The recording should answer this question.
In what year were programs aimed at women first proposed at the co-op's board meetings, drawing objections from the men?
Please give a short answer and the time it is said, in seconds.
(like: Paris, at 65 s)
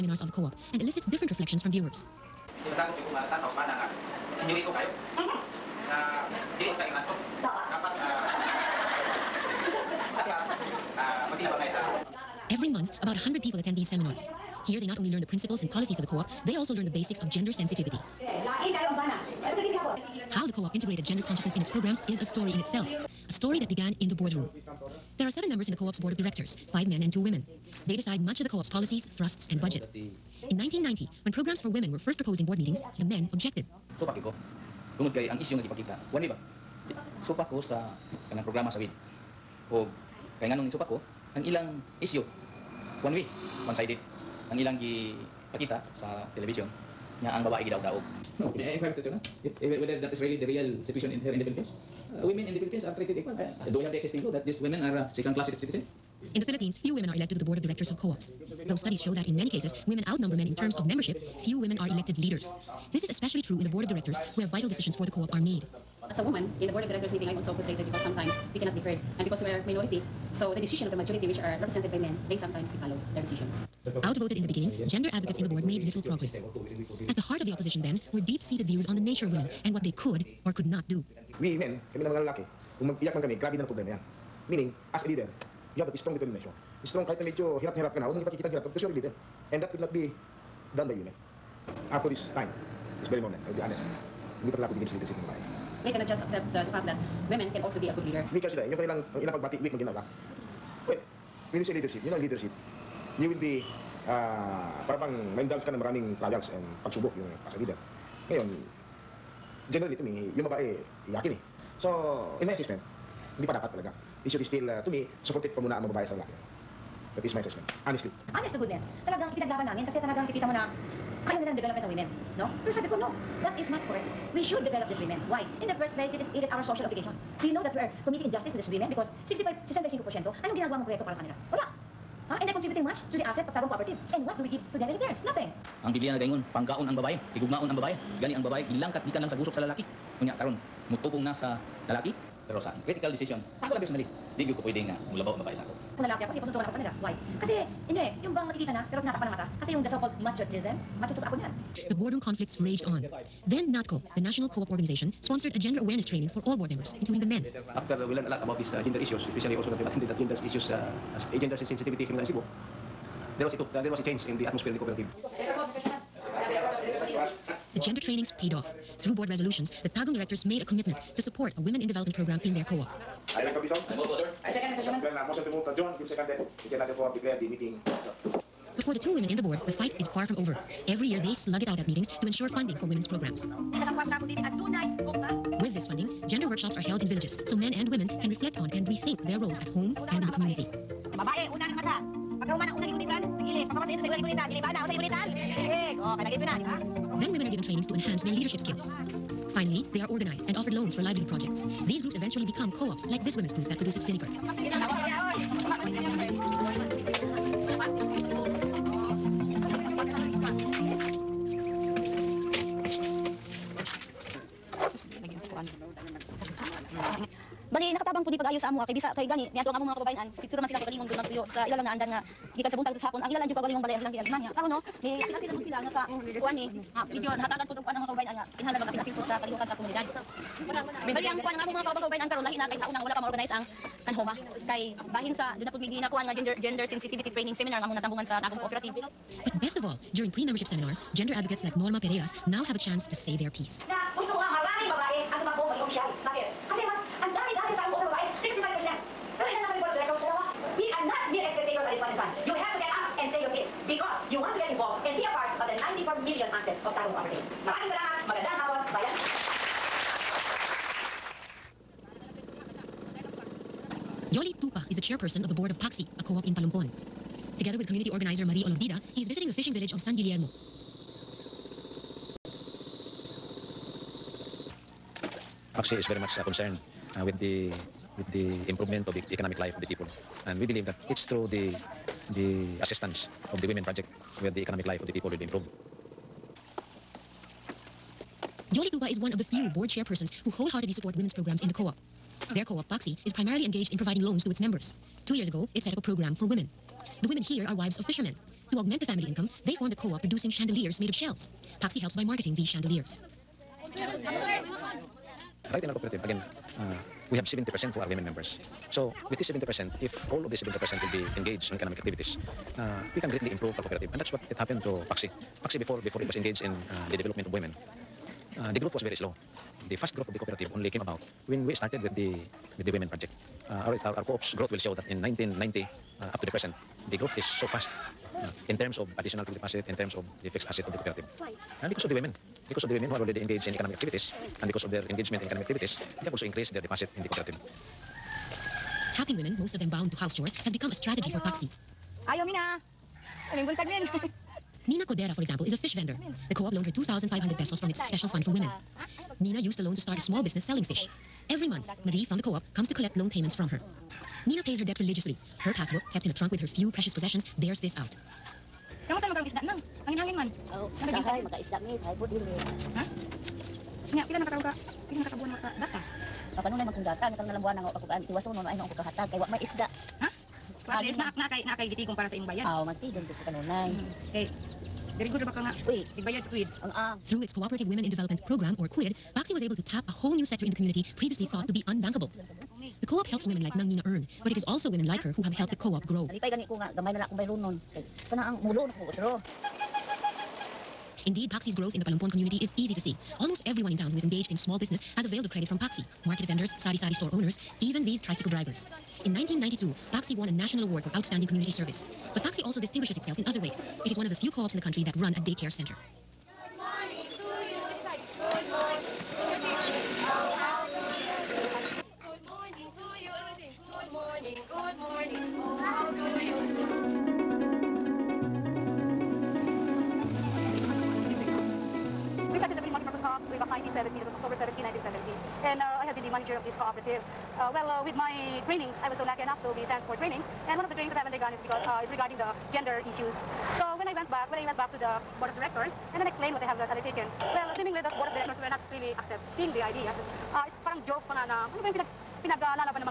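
1990, at 30 s.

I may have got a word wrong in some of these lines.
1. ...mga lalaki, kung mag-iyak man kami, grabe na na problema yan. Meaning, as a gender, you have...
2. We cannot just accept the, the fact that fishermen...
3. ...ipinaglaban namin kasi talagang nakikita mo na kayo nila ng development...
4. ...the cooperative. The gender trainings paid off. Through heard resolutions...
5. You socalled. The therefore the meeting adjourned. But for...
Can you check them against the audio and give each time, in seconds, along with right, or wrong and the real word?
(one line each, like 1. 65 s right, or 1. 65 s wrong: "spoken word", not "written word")
1. 82 s wrong: "leader", not "gender"
2. 95 s wrong: "women", not "fishermen"
3. 119 s right
4. 164 s wrong: "board", not "heard"
5. 175 s wrong: "seconded", not "socalled".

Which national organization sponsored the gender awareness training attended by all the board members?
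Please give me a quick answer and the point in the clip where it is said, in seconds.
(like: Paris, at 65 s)
NATCO, at 153 s.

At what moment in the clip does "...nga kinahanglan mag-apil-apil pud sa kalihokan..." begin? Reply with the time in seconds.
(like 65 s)
228 s.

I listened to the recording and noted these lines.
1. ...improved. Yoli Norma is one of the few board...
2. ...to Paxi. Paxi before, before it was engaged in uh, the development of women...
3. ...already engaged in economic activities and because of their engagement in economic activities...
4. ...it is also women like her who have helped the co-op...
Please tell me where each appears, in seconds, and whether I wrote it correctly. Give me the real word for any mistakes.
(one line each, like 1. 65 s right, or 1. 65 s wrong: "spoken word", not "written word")
1. 285 s wrong: "Tupa", not "Norma"
2. 314 s right
3. 333 s right
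4. 384 s right.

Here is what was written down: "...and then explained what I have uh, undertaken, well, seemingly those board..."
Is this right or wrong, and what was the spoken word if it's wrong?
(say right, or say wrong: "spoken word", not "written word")
right.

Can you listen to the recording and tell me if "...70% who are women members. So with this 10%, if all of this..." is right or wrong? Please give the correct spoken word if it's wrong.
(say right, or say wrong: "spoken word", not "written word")
wrong: "70", not "10".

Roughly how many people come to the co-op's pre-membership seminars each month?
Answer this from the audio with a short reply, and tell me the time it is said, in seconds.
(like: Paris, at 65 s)
100, at 13 s.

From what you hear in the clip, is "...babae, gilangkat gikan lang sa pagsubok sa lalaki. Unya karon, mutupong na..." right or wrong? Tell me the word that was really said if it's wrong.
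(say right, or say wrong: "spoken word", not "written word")
wrong: "gusok", not "pagsubok".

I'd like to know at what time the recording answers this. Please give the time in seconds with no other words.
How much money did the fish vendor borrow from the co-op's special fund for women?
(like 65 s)
346 s.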